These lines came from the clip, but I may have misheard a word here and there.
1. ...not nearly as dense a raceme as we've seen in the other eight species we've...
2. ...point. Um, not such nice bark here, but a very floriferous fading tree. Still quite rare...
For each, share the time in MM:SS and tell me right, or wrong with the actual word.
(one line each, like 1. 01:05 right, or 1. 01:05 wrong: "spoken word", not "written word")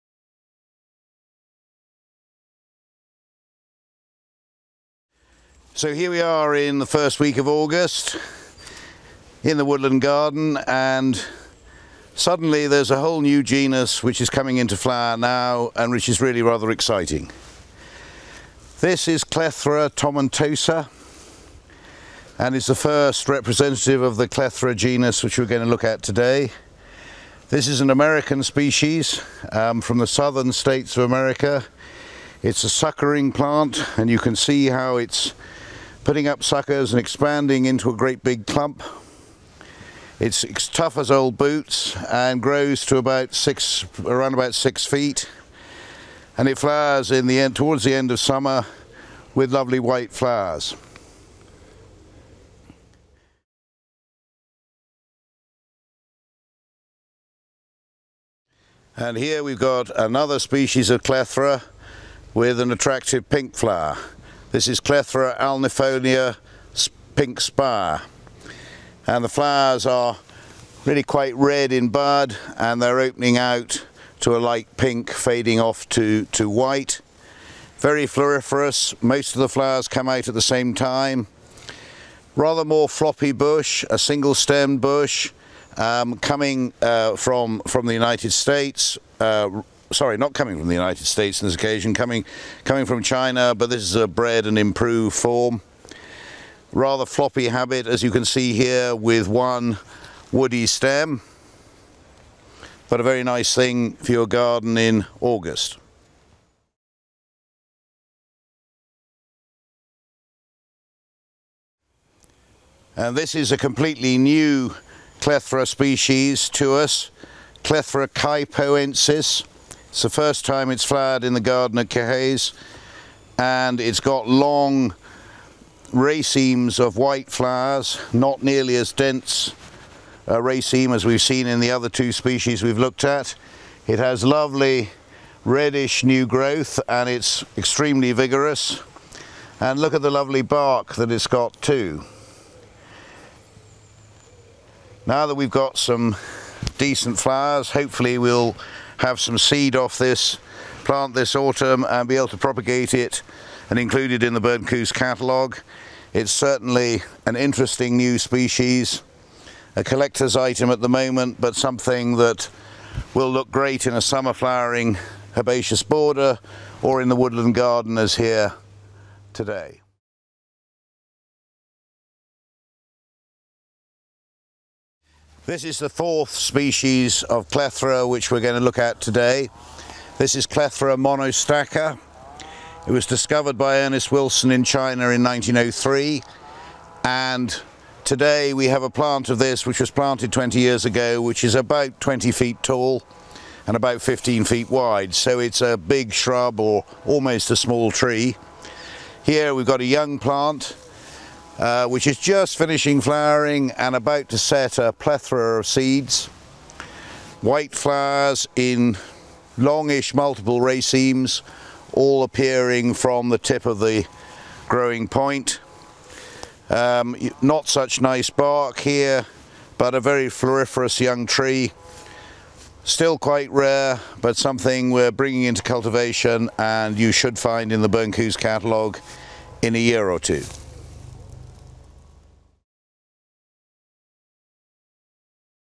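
1. 02:08 wrong: "two", not "eight"
2. 03:35 wrong: "young", not "fading".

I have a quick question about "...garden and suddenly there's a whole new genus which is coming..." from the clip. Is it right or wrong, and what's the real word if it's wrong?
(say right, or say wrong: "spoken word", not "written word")
right.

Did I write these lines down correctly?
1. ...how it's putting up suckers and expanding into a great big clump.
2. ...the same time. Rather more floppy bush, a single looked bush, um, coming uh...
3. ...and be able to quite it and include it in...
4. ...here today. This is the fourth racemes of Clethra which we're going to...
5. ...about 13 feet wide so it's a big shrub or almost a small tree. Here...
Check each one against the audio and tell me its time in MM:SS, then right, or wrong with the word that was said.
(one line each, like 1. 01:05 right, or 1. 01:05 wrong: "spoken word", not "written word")
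1. 00:34 right
2. 01:20 wrong: "stemmed", not "looked"
3. 02:31 wrong: "propagate", not "quite"
4. 02:48 wrong: "species", not "racemes"
5. 03:13 wrong: "15", not "13".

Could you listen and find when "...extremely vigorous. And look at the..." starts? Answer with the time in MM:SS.
02:17.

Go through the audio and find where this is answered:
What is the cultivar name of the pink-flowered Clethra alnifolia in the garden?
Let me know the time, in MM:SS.
01:07.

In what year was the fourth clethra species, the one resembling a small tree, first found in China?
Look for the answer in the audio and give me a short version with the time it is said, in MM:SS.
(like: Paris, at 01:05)
1903, at 03:05.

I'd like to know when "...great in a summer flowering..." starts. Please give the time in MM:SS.
02:43.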